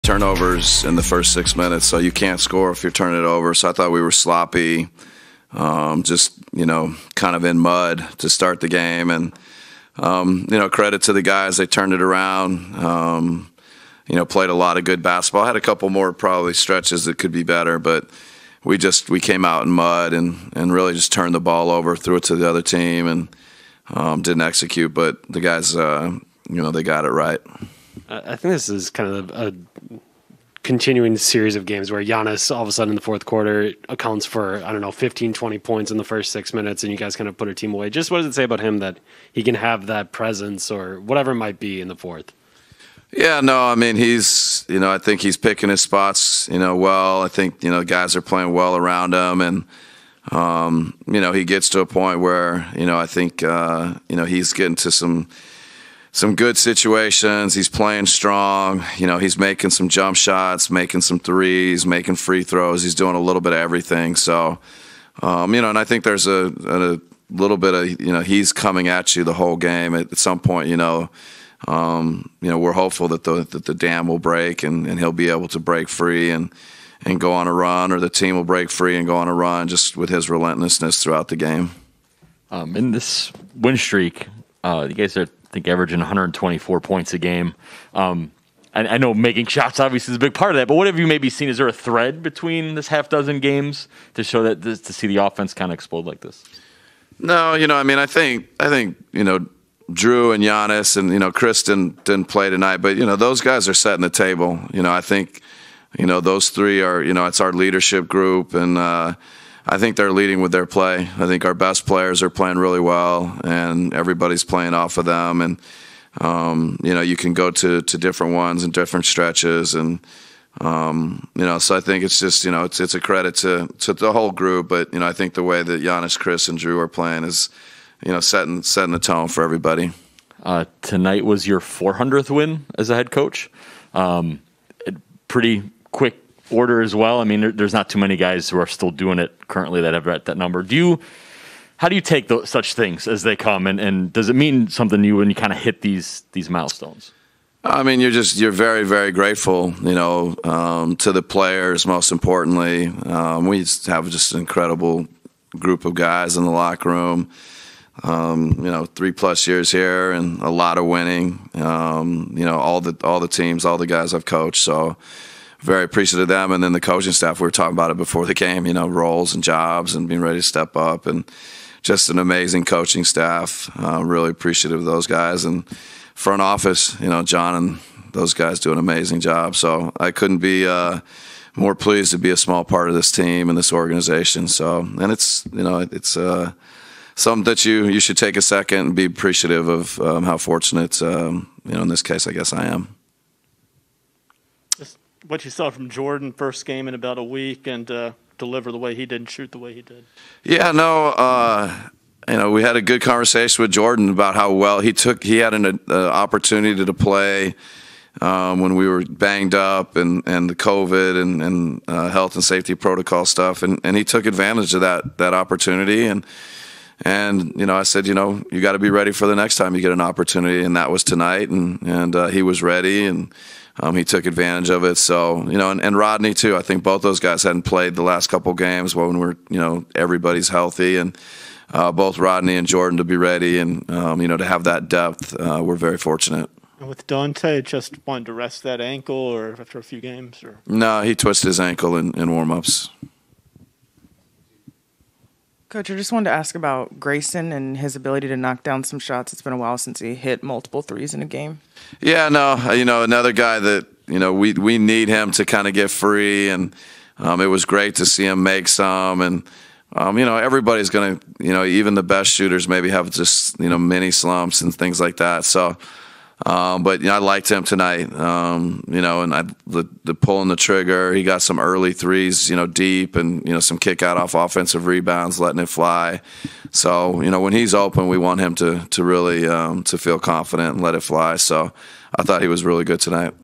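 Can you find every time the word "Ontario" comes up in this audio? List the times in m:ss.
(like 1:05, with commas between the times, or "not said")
not said.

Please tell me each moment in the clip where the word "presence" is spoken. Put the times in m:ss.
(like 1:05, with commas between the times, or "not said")
0:40.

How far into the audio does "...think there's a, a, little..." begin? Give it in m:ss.
1:05.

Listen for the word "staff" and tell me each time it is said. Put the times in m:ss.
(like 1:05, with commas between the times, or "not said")
2:47, 2:53.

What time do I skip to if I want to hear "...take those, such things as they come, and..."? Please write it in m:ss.
2:22.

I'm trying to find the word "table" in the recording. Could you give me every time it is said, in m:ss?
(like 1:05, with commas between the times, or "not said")
1:44.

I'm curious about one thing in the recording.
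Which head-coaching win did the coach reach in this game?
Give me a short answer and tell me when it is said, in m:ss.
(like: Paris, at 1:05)
400th, at 2:11.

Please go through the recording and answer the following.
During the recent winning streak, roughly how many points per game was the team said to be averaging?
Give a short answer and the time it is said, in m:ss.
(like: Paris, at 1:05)
124, at 1:25.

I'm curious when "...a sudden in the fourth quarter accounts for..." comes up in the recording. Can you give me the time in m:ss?
0:32.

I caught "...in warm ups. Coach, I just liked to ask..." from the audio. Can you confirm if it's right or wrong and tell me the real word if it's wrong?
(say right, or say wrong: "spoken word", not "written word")
wrong: "wanted", not "liked".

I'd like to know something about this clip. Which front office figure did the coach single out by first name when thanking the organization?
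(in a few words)
Jon.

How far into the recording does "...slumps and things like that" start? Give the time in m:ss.
4:24.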